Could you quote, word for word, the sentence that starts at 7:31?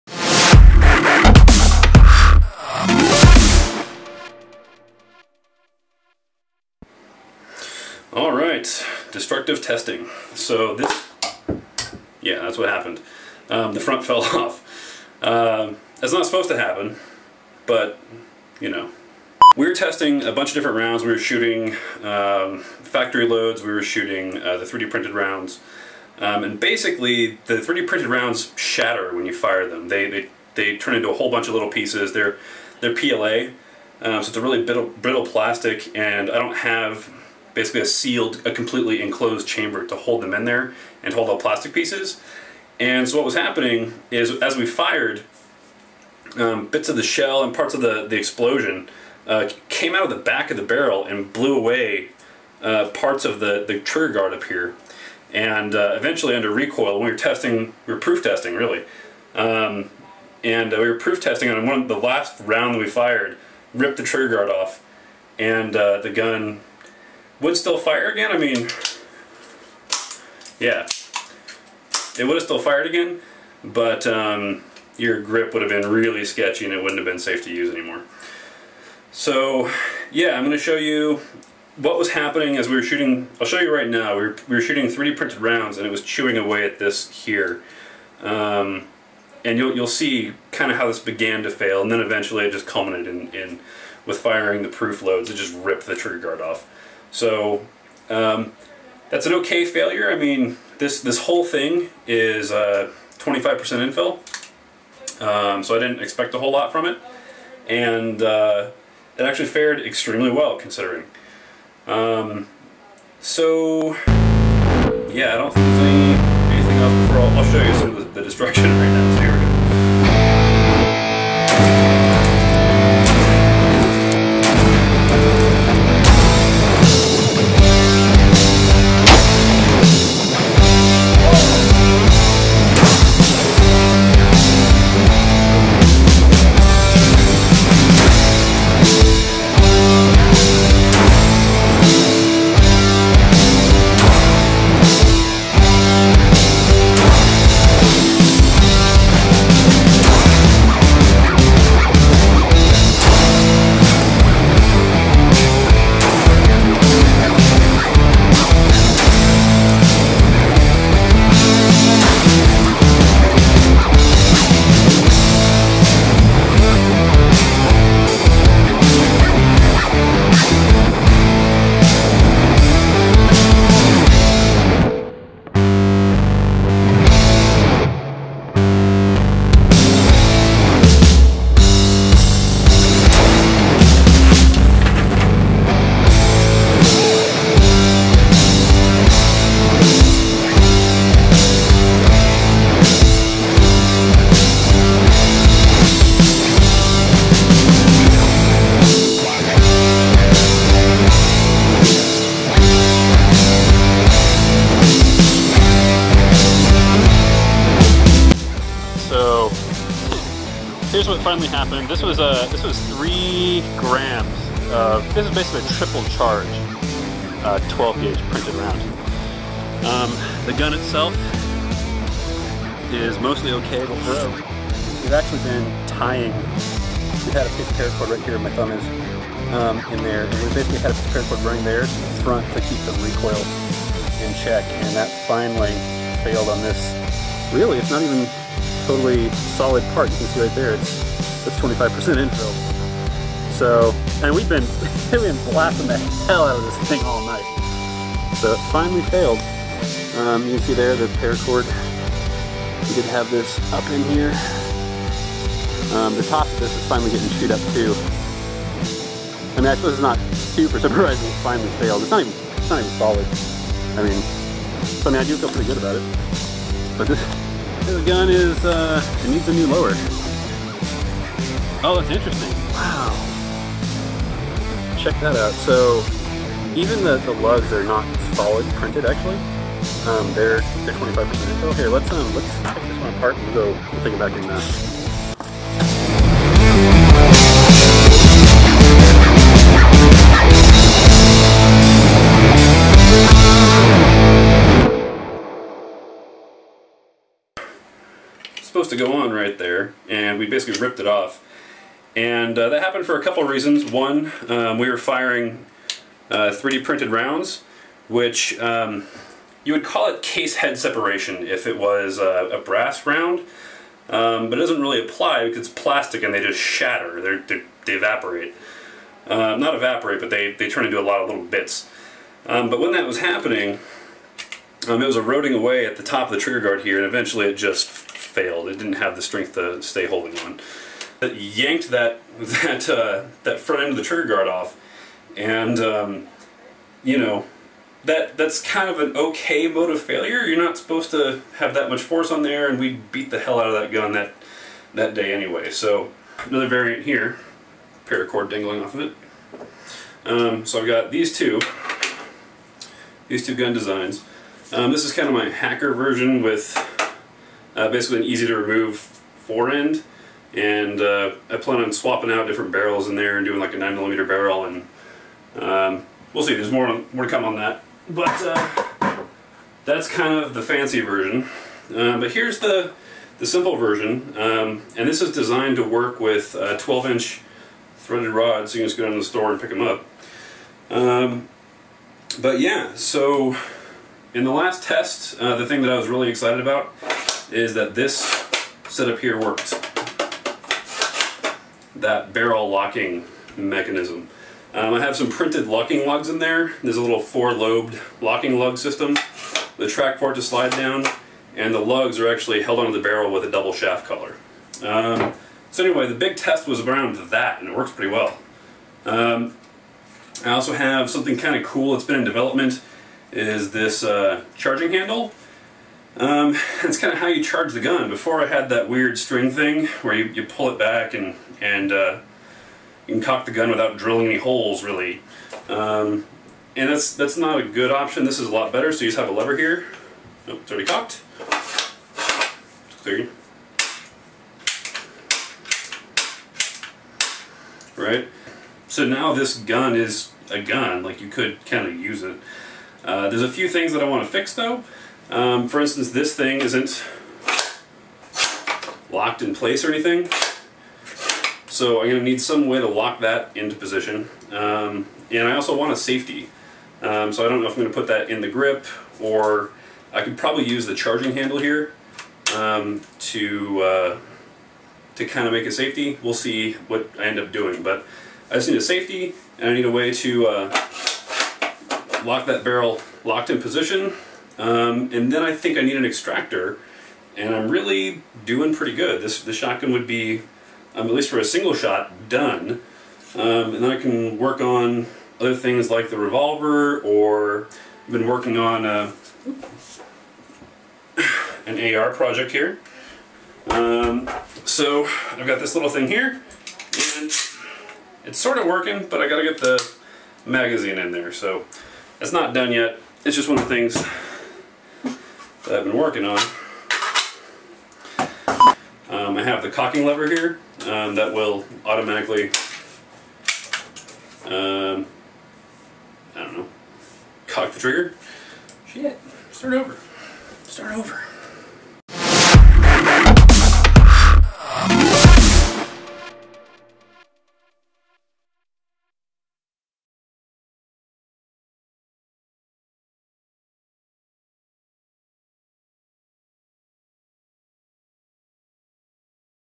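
So I'm going to need some way to lock that into position.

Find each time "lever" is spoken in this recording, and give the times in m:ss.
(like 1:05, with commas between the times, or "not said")
7:09, 8:30.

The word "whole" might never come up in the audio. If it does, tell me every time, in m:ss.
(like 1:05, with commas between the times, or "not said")
0:31, 1:41, 1:46.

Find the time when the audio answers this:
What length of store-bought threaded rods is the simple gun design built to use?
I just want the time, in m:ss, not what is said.
6:16.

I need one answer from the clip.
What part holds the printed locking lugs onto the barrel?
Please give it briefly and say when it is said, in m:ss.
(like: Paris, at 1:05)
Double shaft collar, at 6:43.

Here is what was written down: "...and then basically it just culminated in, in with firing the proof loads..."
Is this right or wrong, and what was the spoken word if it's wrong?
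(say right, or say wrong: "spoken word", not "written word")
wrong: "eventually", not "basically".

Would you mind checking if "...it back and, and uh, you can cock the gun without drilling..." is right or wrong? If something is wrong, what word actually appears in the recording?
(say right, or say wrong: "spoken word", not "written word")
right.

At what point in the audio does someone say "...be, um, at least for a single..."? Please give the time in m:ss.
8:00.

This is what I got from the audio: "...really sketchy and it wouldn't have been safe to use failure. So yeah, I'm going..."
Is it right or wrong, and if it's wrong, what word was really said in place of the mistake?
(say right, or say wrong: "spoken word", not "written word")
wrong: "anymore", not "failure".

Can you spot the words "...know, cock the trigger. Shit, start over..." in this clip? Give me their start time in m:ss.
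8:36.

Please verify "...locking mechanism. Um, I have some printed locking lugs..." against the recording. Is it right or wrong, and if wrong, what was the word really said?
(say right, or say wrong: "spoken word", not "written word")
right.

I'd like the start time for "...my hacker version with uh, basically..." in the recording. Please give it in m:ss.
5:55.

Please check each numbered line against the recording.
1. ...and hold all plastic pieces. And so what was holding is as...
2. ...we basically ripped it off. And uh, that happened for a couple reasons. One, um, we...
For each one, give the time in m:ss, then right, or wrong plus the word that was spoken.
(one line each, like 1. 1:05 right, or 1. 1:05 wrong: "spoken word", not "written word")
1. 0:41 wrong: "happening", not "holding"
2. 5:00 right.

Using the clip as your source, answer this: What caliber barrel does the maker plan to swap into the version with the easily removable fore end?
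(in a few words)
9mm.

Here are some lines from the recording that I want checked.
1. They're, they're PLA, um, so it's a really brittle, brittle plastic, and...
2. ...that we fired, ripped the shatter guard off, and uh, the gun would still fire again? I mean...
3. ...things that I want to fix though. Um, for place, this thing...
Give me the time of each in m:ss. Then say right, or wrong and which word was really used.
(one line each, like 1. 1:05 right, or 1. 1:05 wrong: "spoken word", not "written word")
1. 0:32 right
2. 1:02 wrong: "trigger", not "shatter"
3. 7:23 wrong: "instance", not "place".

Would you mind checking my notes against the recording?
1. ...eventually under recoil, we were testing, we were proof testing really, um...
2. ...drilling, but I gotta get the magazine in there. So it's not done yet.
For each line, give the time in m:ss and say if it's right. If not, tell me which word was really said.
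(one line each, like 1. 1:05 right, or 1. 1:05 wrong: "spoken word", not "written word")
1. 0:55 right
2. 8:18 wrong: "working", not "drilling".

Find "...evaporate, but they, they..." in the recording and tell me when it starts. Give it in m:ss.
5:19.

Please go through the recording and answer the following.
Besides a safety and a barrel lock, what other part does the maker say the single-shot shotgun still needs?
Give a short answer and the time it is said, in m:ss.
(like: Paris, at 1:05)
An extractor, at 7:56.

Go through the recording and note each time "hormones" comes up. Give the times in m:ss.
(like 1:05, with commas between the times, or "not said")
not said.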